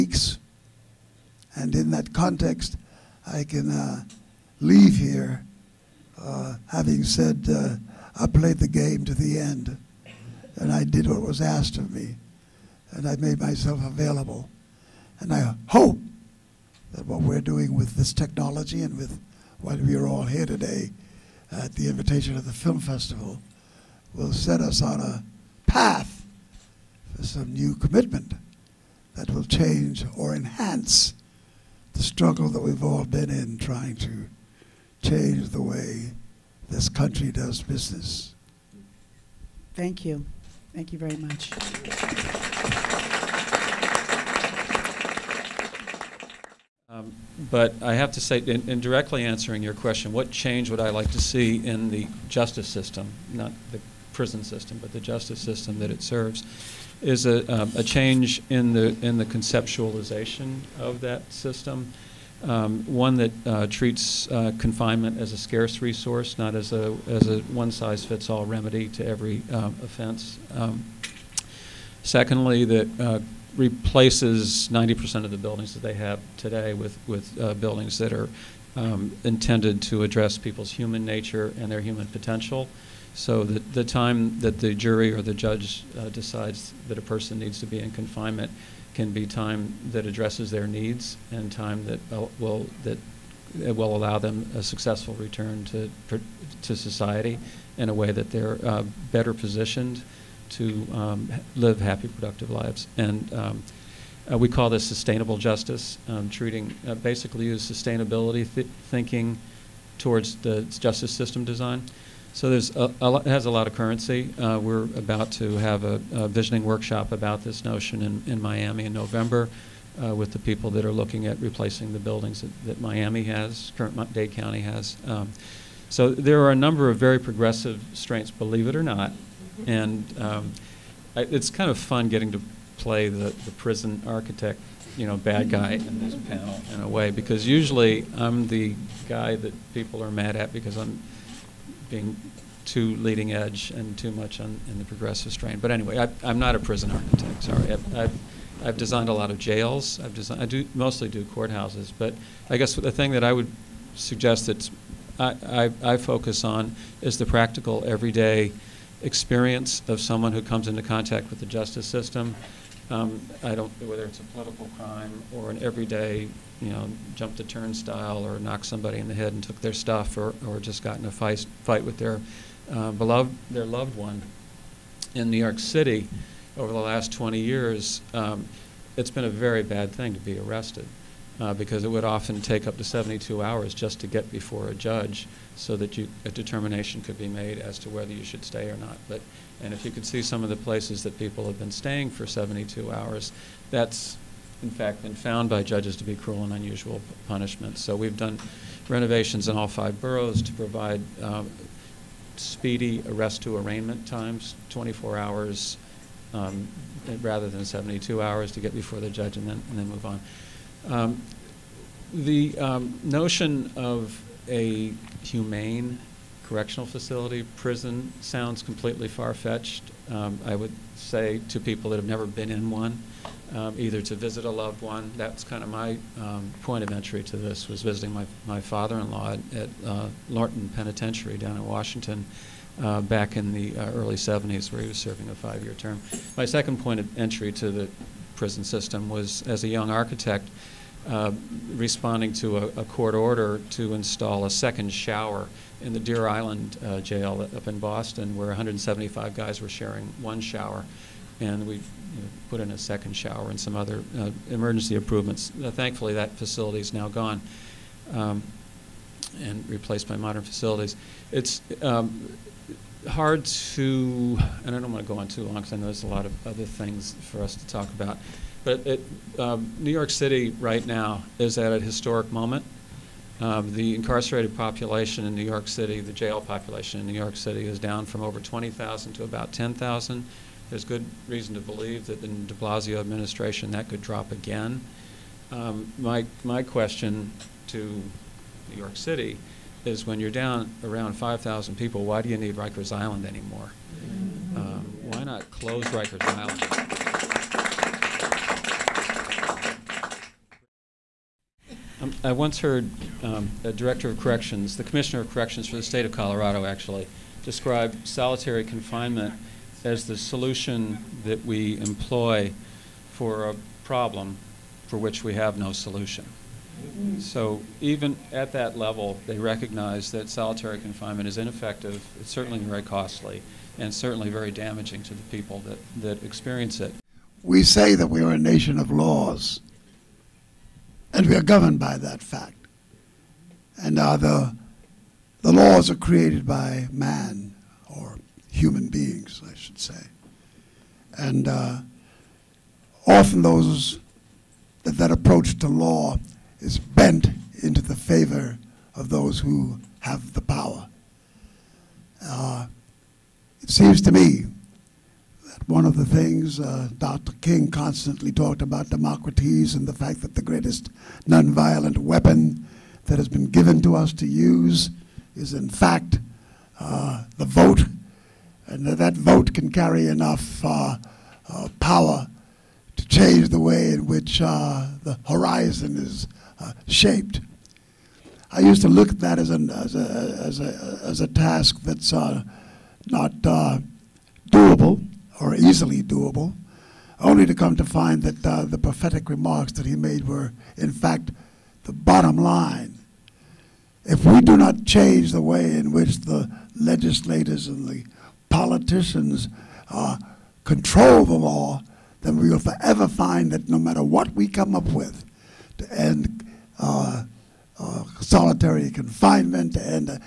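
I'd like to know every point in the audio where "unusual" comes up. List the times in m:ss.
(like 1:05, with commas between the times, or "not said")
3:16.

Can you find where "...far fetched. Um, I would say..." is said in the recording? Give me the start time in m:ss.
3:39.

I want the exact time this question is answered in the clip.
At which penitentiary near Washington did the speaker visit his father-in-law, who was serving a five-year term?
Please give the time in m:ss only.
3:50.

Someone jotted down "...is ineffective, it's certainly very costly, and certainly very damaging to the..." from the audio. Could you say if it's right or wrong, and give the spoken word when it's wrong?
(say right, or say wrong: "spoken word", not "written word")
right.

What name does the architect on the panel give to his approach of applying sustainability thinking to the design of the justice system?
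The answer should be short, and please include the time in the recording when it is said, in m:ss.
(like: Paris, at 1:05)
sustainable justice, at 1:44.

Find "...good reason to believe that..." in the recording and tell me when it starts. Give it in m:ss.
4:40.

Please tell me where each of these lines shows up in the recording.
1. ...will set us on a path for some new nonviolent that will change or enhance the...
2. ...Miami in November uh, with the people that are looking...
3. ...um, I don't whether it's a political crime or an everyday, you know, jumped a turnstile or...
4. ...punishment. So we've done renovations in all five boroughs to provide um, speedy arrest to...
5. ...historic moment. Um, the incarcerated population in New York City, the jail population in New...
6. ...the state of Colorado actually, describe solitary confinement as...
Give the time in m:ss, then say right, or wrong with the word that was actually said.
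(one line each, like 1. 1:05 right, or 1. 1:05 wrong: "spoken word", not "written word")
1. 0:24 wrong: "commitment", not "nonviolent"
2. 1:58 right
3. 2:42 right
4. 3:17 right
5. 4:31 right
6. 5:05 right.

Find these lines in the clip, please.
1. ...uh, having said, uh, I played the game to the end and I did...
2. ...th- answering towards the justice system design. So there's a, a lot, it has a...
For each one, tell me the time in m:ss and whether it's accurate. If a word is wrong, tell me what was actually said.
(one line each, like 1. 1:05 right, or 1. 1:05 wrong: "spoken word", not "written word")
1. 0:06 right
2. 1:48 wrong: "thinking", not "answering".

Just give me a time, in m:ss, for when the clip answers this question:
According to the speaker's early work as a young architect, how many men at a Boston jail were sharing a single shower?
4:08.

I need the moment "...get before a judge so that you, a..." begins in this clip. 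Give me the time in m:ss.
3:04.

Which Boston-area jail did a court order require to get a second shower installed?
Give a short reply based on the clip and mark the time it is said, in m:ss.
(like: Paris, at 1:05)
Deer Island, at 4:05.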